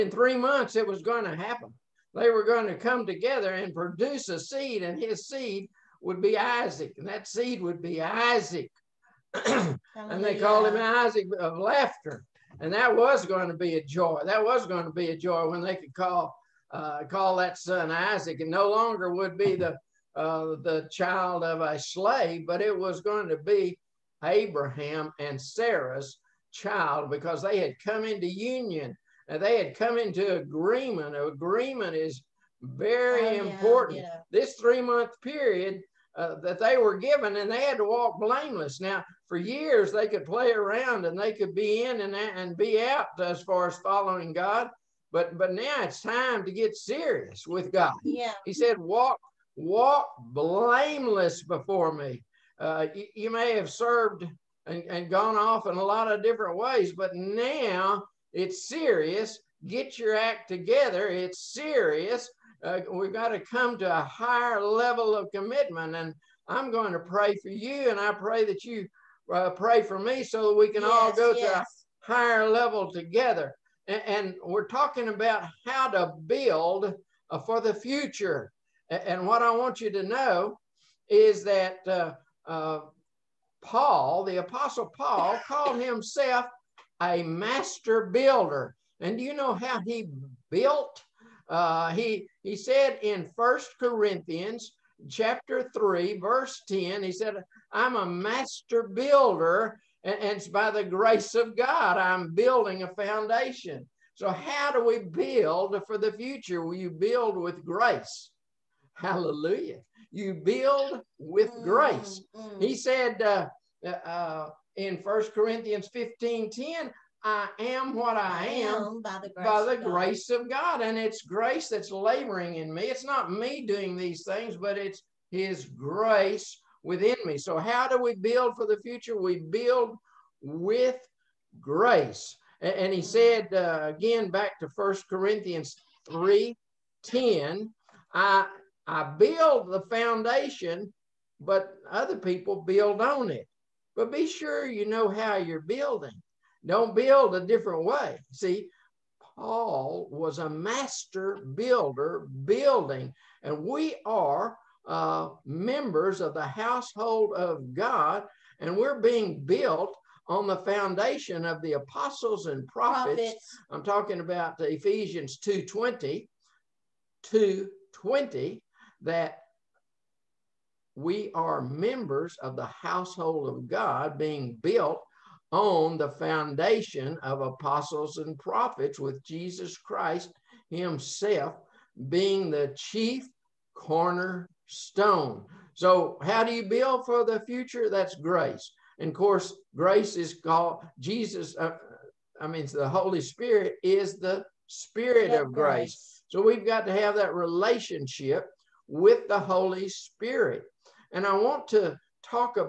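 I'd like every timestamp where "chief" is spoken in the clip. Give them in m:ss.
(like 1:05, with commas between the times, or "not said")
3:02.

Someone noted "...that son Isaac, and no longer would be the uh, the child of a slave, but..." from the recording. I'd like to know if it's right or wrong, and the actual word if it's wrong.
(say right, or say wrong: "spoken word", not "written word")
right.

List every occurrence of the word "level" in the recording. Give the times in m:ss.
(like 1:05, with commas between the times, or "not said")
1:04, 1:12.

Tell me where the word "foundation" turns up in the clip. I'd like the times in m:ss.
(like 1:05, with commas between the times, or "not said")
1:42, 2:19, 2:40, 2:56.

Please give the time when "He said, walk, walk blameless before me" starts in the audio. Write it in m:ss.
0:48.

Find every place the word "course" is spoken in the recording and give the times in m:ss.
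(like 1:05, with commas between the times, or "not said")
3:09.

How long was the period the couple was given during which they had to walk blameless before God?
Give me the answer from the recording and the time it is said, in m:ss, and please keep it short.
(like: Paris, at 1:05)
3 months, at 0:00.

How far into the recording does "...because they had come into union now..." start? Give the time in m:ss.
0:27.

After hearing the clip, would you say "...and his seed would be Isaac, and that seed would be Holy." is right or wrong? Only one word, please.
wrong.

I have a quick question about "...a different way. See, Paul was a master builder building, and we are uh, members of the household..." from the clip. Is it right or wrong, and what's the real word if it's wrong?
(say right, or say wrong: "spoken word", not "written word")
right.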